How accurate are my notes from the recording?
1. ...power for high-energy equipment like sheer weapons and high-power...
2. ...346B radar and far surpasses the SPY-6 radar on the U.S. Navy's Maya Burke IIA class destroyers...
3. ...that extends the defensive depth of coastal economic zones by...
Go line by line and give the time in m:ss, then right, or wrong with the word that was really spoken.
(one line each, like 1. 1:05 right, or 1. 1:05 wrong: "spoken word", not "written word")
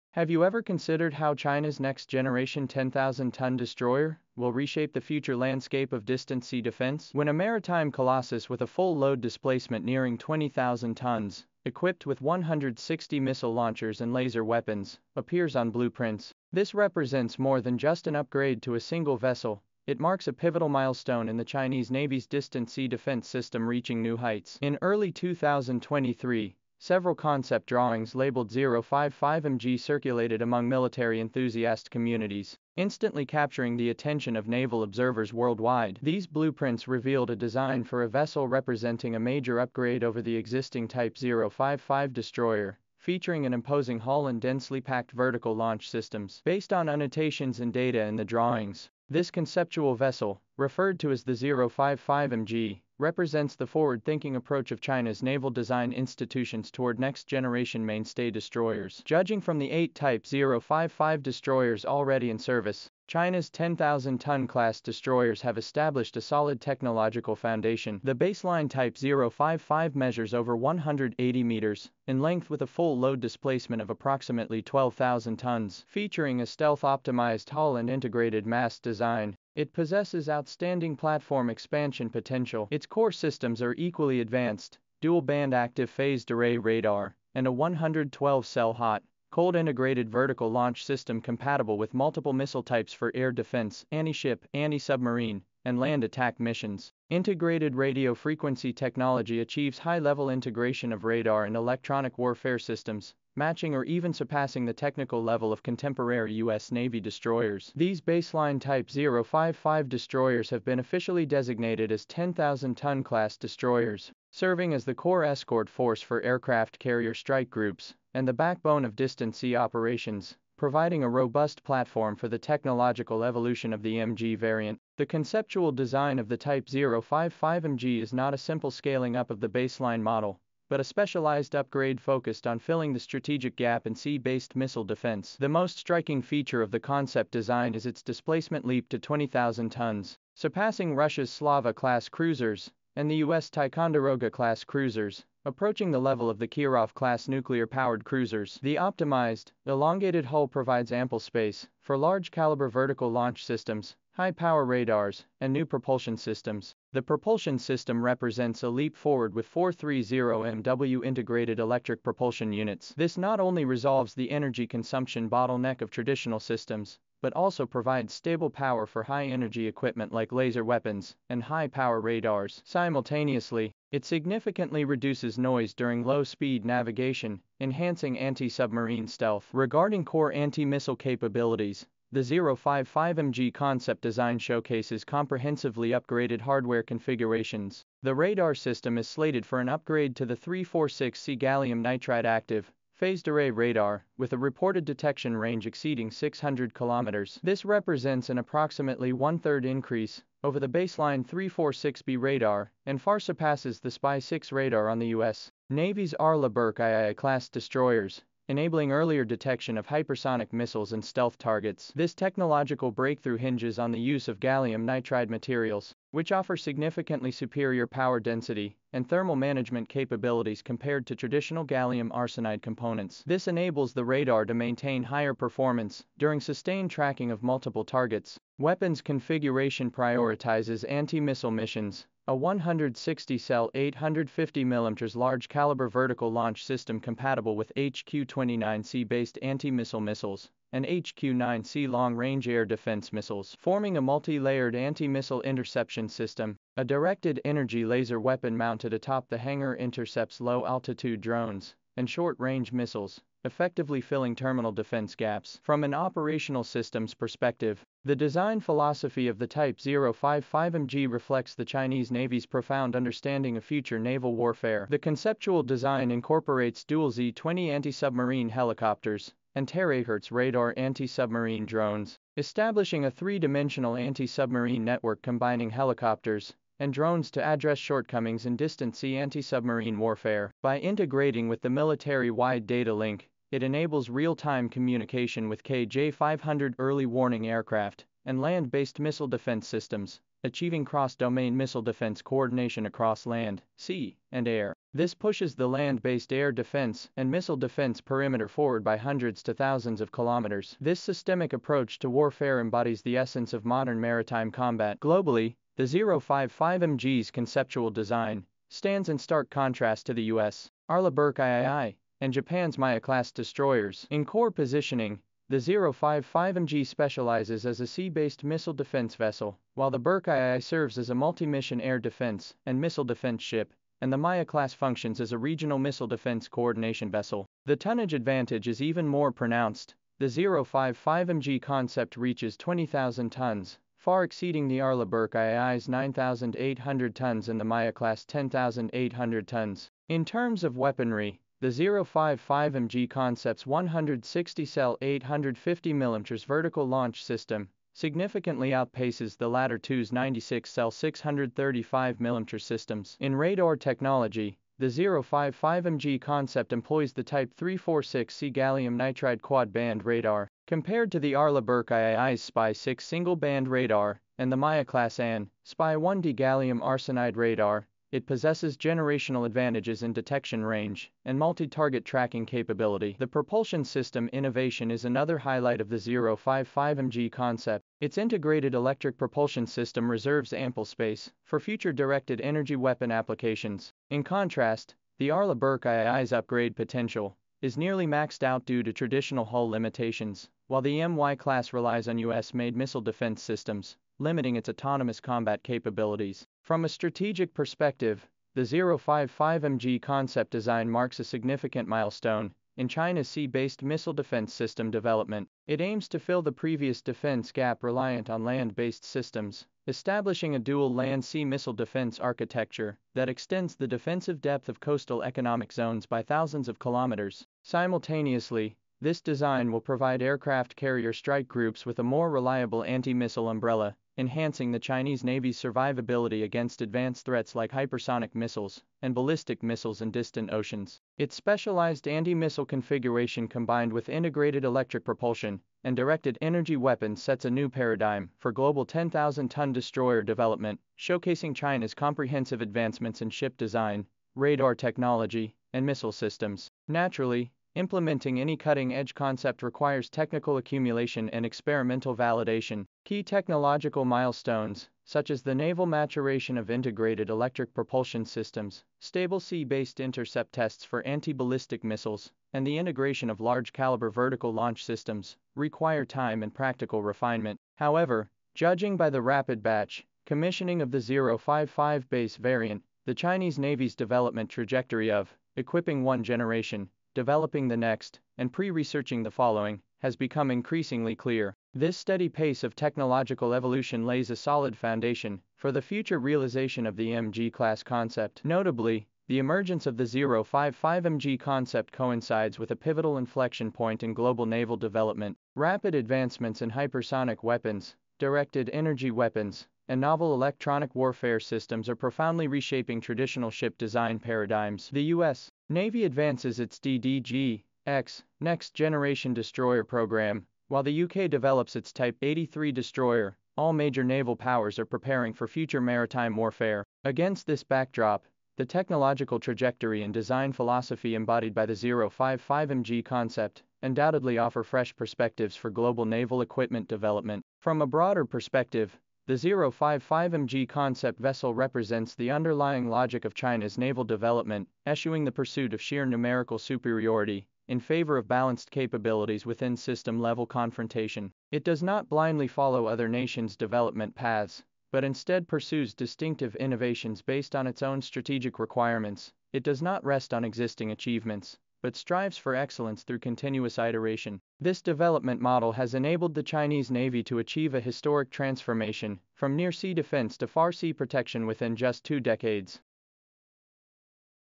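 1. 2:48 wrong: "laser", not "sheer"
2. 3:21 wrong: "Arleigh", not "Maya"
3. 6:53 right.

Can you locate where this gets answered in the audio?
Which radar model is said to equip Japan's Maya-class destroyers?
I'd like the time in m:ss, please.
6:05.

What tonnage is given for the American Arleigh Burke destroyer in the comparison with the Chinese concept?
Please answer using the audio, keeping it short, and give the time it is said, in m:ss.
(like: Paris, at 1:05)
9,800 tons, at 5:35.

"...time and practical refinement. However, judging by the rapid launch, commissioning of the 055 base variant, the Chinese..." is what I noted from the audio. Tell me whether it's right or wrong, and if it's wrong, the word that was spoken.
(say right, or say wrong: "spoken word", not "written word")
wrong: "batch", not "launch".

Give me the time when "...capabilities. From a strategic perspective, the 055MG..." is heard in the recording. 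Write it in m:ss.
6:35.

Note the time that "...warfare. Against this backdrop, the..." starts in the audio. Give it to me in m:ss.
8:36.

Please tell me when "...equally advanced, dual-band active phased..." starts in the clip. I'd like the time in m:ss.
1:23.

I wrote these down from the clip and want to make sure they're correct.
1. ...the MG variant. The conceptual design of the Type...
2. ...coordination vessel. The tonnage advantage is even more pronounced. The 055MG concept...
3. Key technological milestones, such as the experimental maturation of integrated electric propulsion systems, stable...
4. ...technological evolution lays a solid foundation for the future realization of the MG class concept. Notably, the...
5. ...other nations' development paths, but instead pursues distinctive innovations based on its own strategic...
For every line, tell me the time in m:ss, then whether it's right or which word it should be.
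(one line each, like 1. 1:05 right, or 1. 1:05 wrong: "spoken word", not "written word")
1. 2:03 right
2. 5:26 right
3. 7:33 wrong: "naval", not "experimental"
4. 8:02 right
5. 9:02 right.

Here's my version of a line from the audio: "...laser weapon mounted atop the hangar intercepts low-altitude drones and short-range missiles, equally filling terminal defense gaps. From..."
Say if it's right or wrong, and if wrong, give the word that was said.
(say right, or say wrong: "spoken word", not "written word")
wrong: "effectively", not "equally".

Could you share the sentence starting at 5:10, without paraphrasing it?
Arleigh Burke III and Japan's Maya-class destroyers.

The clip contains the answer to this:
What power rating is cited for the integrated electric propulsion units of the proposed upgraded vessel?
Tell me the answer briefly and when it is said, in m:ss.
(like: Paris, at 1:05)
430MW, at 2:39.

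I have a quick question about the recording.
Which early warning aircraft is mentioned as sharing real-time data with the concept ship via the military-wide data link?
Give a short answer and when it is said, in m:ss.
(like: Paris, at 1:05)
KJ-500, at 4:45.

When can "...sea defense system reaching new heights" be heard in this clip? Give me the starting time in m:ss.
0:22.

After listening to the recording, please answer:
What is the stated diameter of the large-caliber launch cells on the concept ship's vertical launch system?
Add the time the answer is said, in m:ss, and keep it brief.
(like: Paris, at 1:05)
850mm, at 3:53.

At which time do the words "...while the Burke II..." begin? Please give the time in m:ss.
5:19.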